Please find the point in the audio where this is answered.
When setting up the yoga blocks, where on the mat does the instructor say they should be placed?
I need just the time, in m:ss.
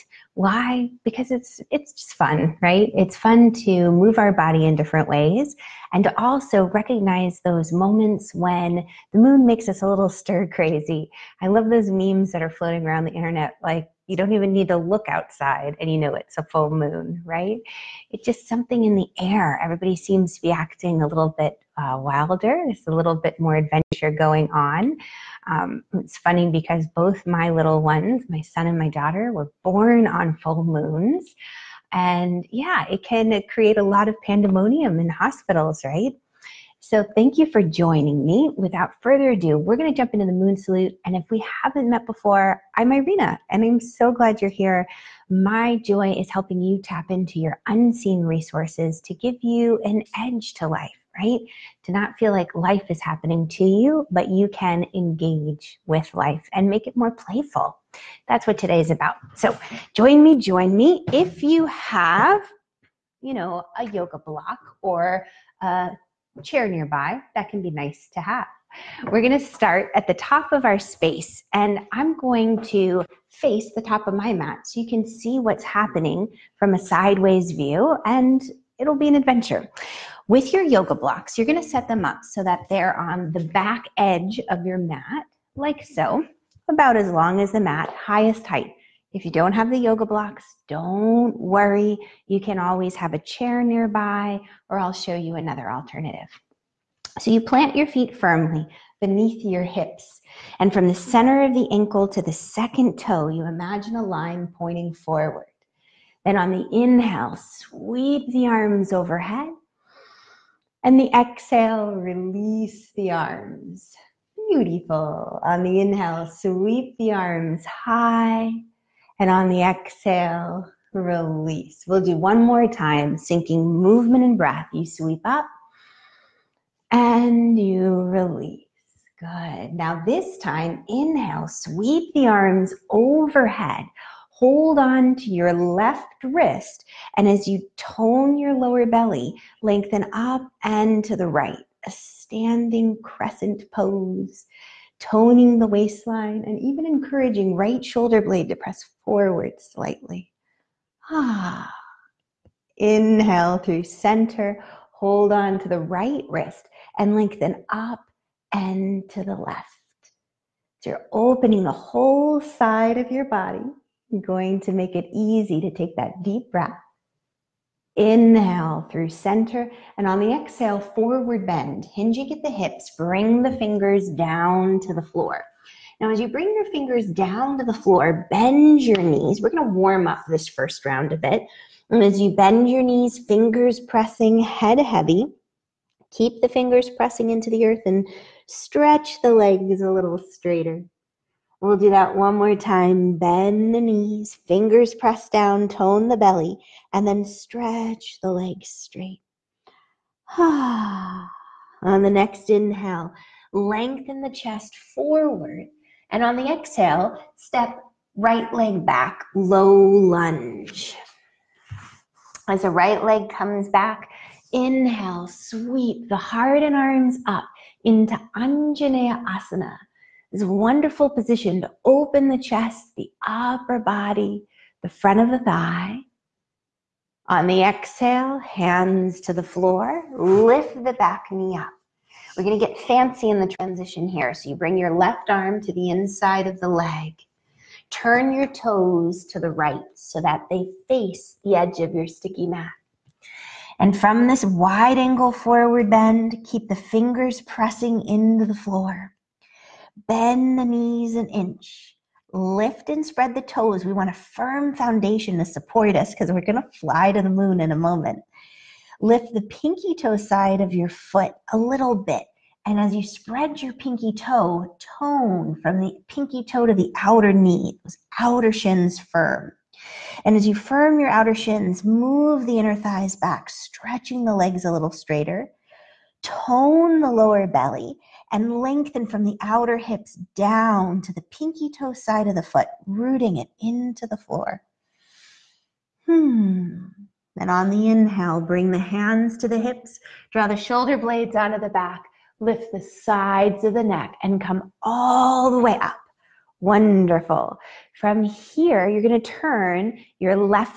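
1:23.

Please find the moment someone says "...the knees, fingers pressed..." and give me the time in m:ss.
3:13.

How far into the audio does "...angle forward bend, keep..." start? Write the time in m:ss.
4:04.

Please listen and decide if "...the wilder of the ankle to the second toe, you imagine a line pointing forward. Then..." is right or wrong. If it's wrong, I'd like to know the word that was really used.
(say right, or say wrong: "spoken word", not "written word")
wrong: "center", not "wilder".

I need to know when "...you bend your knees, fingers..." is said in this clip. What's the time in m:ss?
3:02.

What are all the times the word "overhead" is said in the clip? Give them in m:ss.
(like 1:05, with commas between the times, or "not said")
1:48, 2:12.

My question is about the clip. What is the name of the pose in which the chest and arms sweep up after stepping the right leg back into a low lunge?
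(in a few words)
Anjaneya Asana.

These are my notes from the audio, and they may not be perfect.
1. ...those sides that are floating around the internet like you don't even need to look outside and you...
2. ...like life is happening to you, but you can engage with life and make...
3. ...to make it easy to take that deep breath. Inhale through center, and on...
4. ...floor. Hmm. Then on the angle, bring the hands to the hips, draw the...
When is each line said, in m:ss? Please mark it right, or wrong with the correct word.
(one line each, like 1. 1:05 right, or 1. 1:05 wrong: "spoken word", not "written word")
1. 0:11 wrong: "memes", not "sides"
2. 0:52 right
3. 2:44 right
4. 4:44 wrong: "inhale", not "angle".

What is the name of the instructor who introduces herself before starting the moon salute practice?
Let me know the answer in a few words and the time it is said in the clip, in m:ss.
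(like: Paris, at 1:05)
Irena, at 0:42.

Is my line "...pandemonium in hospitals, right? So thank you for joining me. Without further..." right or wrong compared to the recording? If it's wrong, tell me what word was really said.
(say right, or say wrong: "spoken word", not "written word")
right.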